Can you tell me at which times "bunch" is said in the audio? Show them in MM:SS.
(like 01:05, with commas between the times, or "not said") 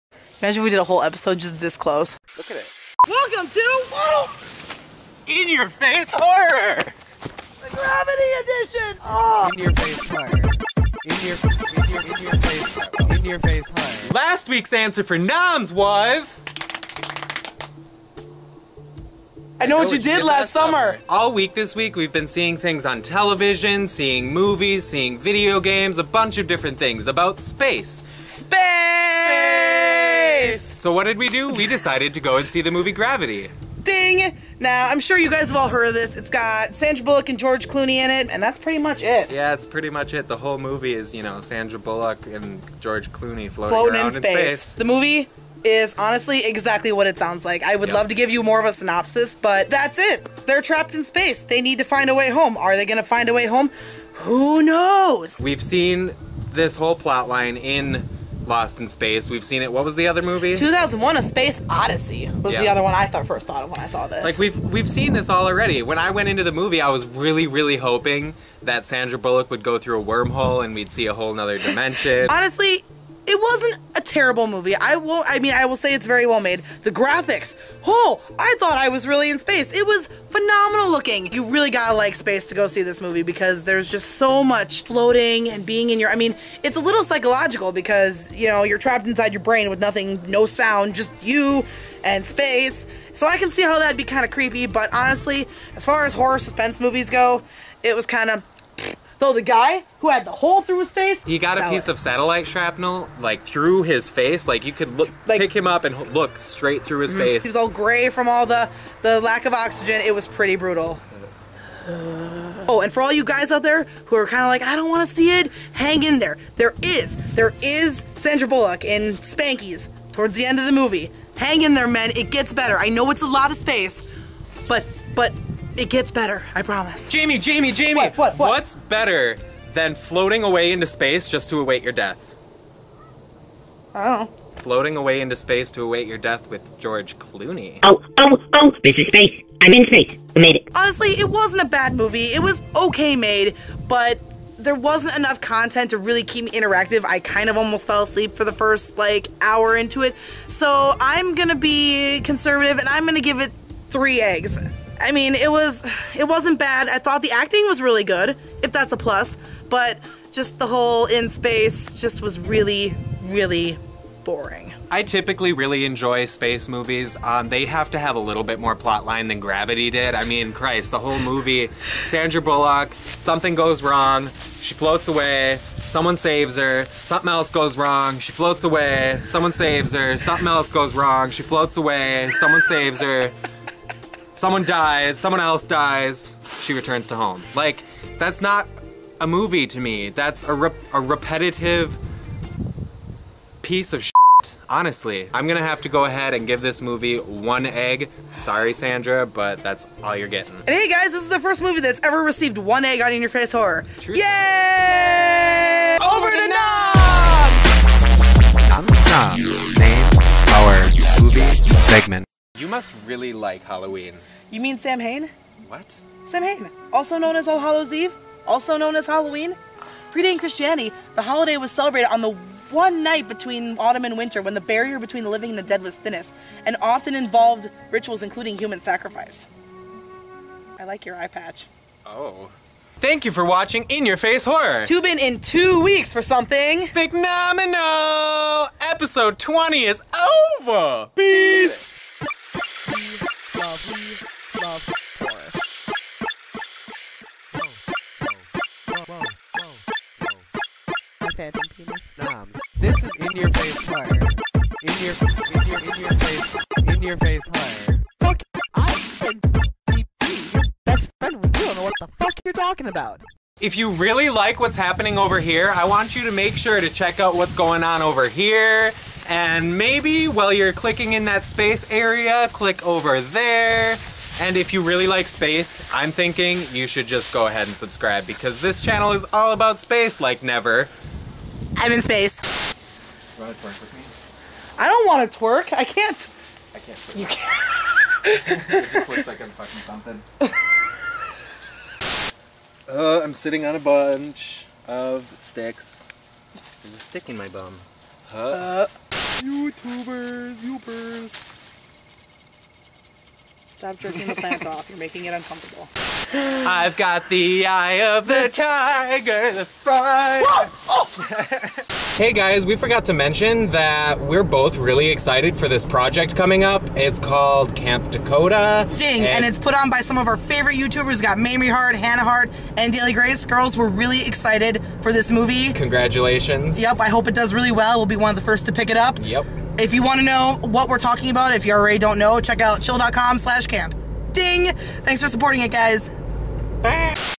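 00:26, 04:53.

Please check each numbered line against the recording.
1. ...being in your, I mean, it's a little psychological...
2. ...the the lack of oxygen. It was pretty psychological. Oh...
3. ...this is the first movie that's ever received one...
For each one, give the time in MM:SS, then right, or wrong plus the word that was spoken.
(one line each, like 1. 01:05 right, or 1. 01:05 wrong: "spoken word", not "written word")
1. 01:25 right
2. 01:48 wrong: "brutal", not "psychological"
3. 03:21 right.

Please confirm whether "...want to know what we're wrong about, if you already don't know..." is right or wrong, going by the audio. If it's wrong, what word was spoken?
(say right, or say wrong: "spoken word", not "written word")
wrong: "talking", not "wrong".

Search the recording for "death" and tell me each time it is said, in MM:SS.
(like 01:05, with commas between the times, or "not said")
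02:11, 02:16.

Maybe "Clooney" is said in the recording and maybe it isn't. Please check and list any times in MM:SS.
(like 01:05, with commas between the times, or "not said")
00:37, 00:43, 02:17.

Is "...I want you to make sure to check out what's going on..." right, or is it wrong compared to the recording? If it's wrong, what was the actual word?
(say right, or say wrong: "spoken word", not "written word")
right.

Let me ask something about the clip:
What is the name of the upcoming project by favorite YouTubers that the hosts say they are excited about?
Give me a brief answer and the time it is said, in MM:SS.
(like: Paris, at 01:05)
Camp Takota, at 05:17.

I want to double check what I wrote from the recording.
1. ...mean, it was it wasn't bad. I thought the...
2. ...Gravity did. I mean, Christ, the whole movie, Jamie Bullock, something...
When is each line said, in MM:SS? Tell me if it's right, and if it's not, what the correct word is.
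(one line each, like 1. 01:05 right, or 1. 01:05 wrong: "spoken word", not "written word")
1. 02:35 right
2. 02:49 wrong: "Sandra", not "Jamie".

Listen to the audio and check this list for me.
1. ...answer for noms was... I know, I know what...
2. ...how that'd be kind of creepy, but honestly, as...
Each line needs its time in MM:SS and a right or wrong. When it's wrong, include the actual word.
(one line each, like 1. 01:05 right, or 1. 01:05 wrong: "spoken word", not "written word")
1. 00:14 right
2. 01:33 right.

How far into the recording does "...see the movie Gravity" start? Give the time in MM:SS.
00:32.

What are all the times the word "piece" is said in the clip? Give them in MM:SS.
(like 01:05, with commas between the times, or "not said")
01:41, 03:13.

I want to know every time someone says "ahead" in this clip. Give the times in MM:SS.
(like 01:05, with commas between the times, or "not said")
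03:16, 04:37.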